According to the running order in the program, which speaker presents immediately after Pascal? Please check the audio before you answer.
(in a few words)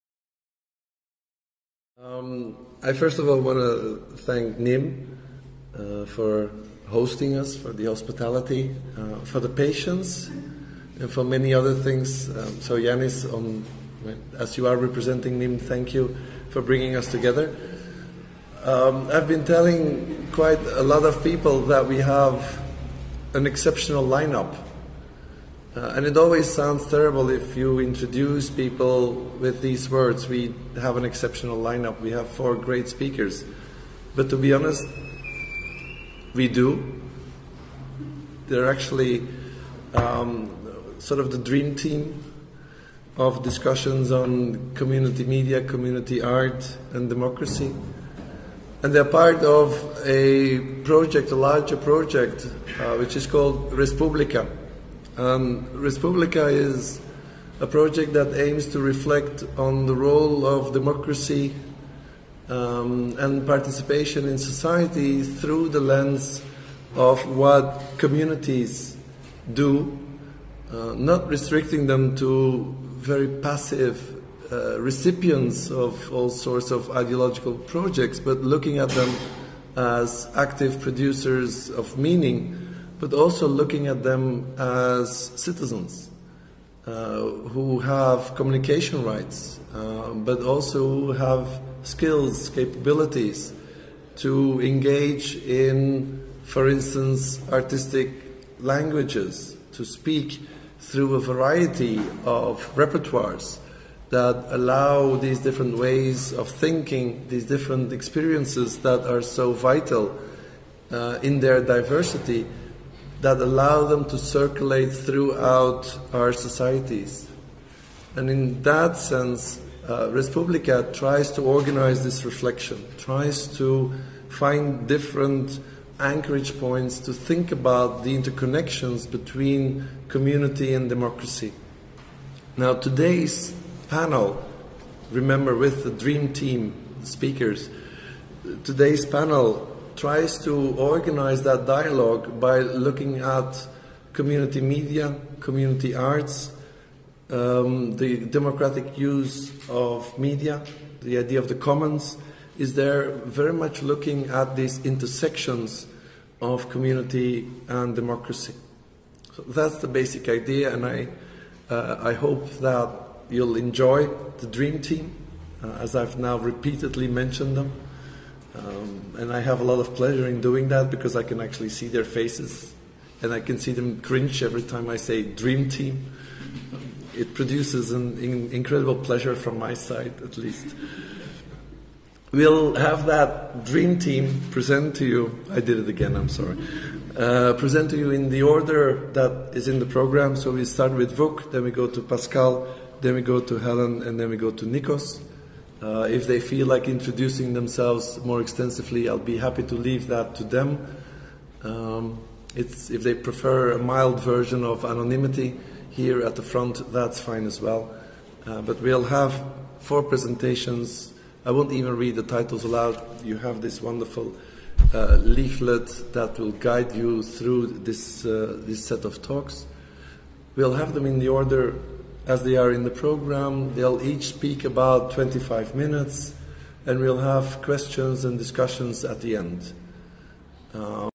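Helen.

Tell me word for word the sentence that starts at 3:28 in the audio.
Uh, but we'll have four presentations.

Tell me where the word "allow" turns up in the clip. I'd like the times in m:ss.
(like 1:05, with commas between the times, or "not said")
1:44, 1:53.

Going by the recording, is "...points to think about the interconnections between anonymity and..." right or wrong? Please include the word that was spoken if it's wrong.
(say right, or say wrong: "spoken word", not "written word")
wrong: "community", not "anonymity".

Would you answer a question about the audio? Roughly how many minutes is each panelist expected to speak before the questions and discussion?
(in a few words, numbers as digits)
25.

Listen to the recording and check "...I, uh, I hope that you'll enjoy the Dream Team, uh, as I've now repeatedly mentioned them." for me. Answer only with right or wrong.
right.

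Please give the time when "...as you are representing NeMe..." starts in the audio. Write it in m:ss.
0:14.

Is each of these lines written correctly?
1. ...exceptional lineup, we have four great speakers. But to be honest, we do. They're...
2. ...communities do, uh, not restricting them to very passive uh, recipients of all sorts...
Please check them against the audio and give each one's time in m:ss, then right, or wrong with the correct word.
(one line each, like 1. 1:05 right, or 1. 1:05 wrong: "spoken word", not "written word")
1. 0:31 right
2. 1:07 right.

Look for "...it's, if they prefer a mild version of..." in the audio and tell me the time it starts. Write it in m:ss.
3:22.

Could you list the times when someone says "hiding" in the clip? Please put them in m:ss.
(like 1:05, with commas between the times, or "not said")
not said.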